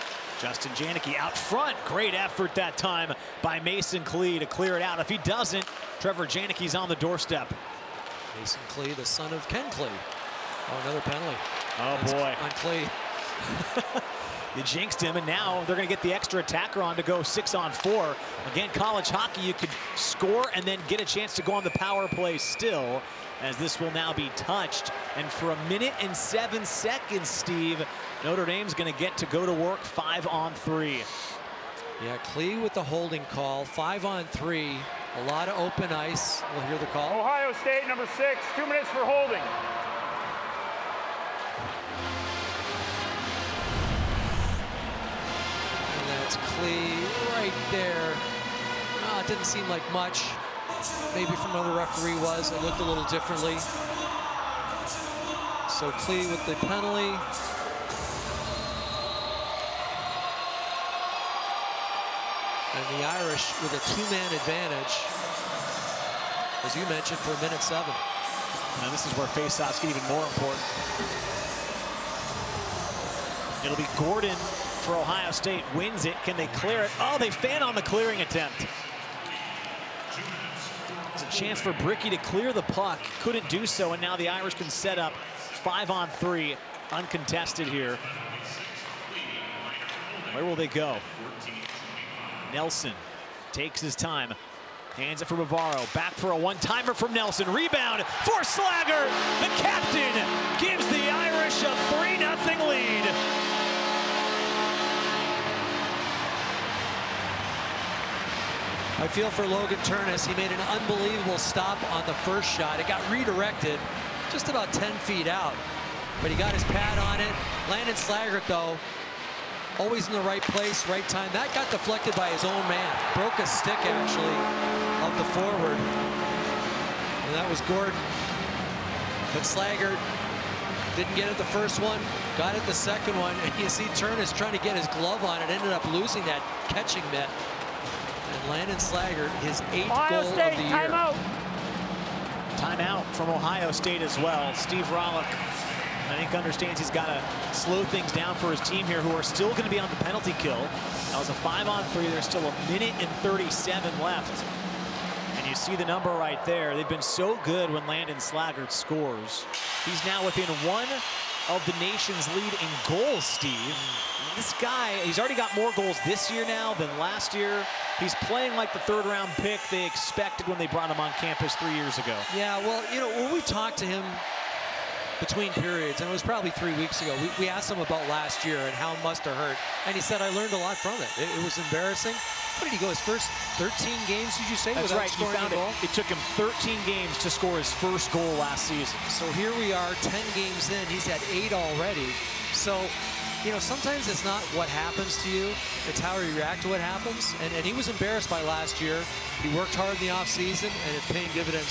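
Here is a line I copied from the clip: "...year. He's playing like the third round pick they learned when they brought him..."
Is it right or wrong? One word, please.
wrong.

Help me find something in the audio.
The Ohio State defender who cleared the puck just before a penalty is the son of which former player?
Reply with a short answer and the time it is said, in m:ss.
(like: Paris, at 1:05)
Ken Klee, at 0:09.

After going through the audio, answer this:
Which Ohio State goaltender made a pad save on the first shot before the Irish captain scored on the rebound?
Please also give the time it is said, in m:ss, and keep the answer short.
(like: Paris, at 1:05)
Logan Terness, at 1:49.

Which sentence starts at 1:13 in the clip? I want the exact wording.
It'll be Gordon for Ohio State, wins it.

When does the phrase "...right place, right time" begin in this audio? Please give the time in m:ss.
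2:00.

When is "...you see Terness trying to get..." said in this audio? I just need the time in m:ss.
2:13.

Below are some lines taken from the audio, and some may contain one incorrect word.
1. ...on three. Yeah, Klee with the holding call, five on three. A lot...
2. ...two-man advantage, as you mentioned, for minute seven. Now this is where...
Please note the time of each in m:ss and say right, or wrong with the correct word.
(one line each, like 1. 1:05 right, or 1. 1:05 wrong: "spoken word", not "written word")
1. 0:30 right
2. 1:03 right.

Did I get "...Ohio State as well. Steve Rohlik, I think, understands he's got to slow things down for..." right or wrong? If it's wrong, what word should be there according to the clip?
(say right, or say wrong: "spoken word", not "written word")
right.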